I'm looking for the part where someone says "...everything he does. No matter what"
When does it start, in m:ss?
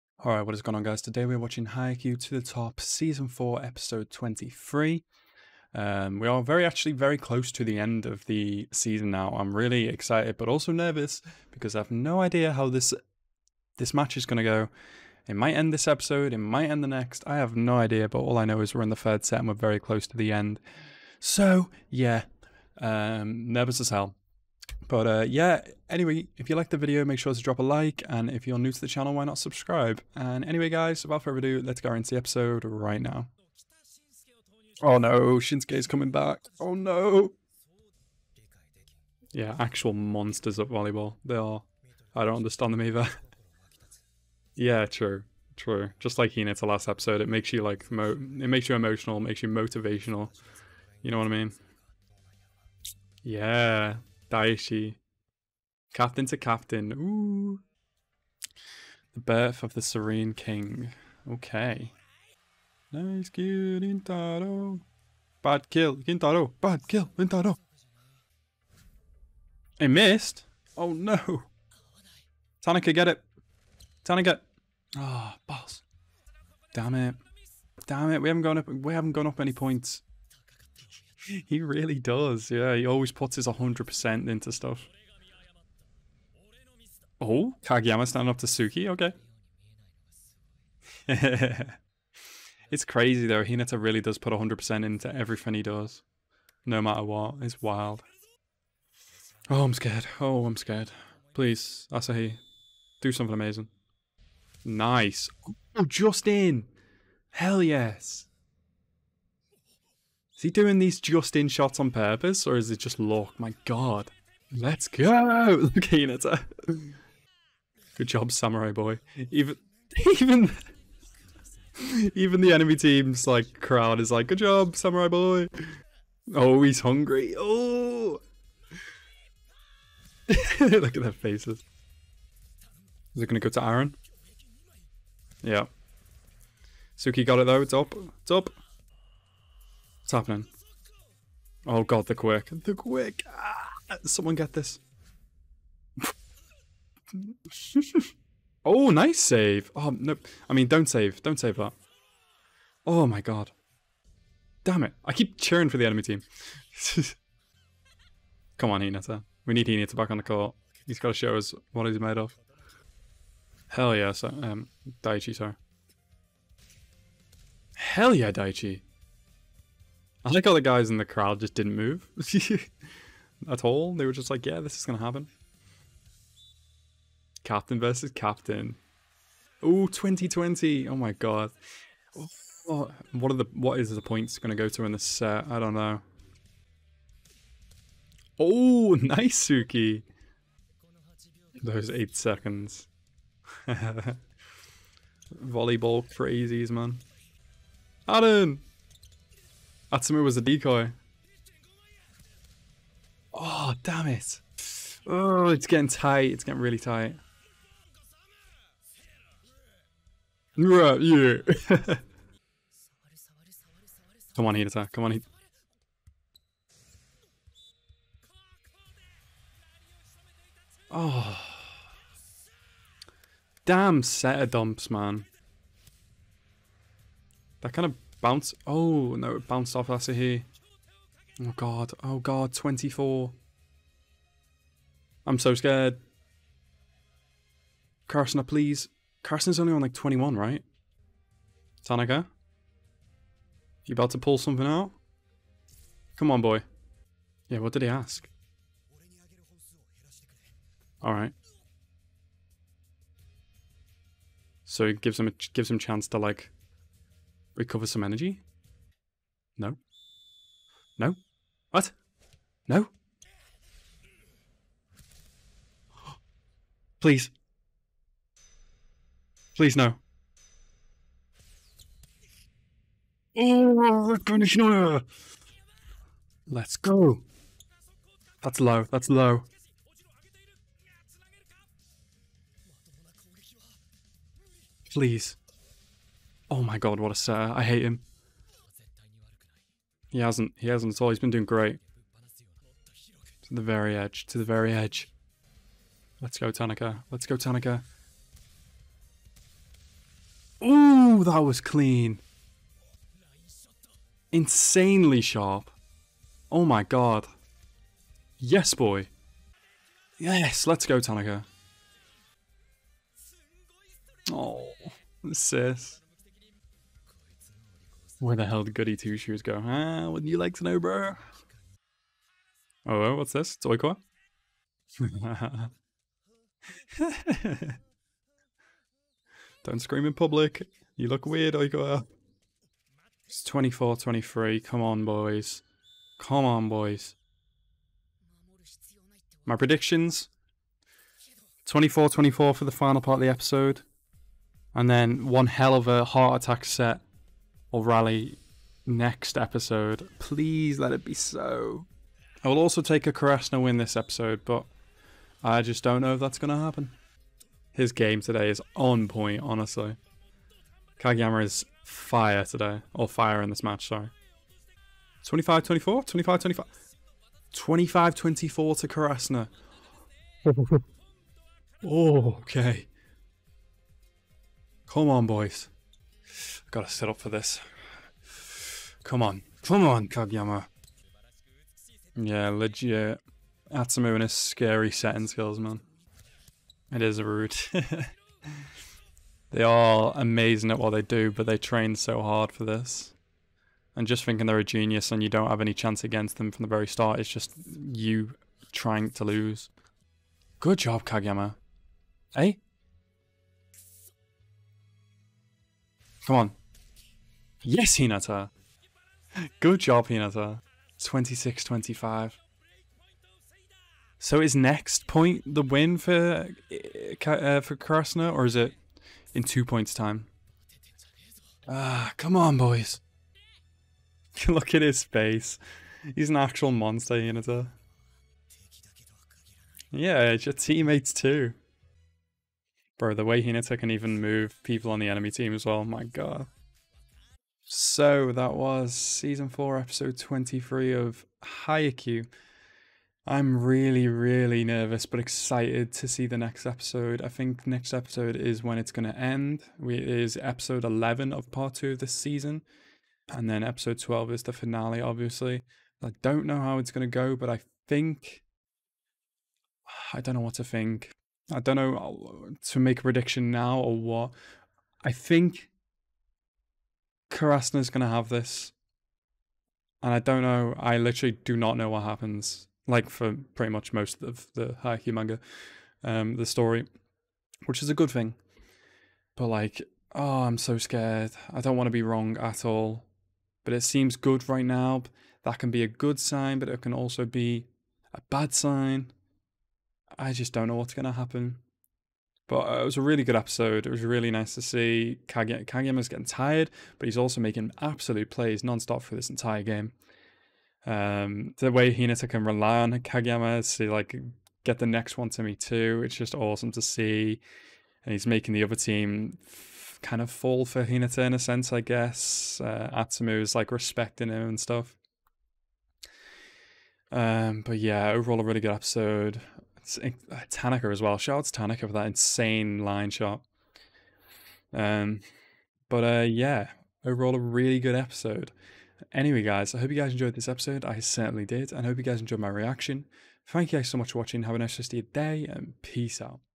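1:35.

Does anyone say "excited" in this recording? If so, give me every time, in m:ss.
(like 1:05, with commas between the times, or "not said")
0:09, 7:25.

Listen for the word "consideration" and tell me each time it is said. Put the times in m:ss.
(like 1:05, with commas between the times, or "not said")
not said.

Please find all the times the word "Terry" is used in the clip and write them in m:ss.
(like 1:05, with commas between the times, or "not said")
not said.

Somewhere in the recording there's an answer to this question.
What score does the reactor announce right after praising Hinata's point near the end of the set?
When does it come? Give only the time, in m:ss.
6:51.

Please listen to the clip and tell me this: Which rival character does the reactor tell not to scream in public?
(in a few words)
Oikawa.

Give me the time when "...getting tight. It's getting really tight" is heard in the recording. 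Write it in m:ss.
3:25.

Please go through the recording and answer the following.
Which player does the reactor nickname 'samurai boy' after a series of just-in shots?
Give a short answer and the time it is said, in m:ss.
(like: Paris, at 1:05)
Asahi, at 1:41.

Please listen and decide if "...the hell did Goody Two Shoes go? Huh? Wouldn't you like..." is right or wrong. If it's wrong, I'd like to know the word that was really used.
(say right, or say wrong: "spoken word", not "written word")
right.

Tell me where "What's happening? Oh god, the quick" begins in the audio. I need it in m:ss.
2:20.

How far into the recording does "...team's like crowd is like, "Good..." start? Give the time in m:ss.
2:02.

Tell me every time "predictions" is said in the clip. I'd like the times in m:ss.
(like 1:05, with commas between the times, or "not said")
5:39, 7:43.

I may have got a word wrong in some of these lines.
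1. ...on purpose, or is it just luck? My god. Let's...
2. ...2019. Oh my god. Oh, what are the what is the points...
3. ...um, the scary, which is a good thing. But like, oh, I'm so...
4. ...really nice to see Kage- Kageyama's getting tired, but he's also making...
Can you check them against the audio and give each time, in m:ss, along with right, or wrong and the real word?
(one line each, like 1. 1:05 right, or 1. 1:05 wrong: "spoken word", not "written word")
1. 1:51 right
2. 2:59 wrong: "2020", not "2019"
3. 7:56 wrong: "story", not "scary"
4. 8:14 right.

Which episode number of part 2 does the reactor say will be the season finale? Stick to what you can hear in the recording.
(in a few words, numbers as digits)
12.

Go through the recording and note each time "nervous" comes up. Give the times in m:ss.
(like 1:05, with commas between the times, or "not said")
0:10, 0:23, 7:24.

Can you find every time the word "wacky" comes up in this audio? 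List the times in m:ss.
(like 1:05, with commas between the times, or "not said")
not said.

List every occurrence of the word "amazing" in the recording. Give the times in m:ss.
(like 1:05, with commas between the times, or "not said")
1:43, 6:30.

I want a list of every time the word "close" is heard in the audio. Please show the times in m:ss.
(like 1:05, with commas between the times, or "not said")
0:07, 0:19.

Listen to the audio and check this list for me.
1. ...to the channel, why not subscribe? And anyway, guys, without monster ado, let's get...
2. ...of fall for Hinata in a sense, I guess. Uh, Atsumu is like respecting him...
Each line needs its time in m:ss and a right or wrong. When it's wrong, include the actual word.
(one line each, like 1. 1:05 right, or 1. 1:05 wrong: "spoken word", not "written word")
1. 0:28 wrong: "further", not "monster"
2. 8:30 right.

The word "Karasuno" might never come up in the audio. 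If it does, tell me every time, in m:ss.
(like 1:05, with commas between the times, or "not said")
5:53, 6:08, 6:57, 7:47.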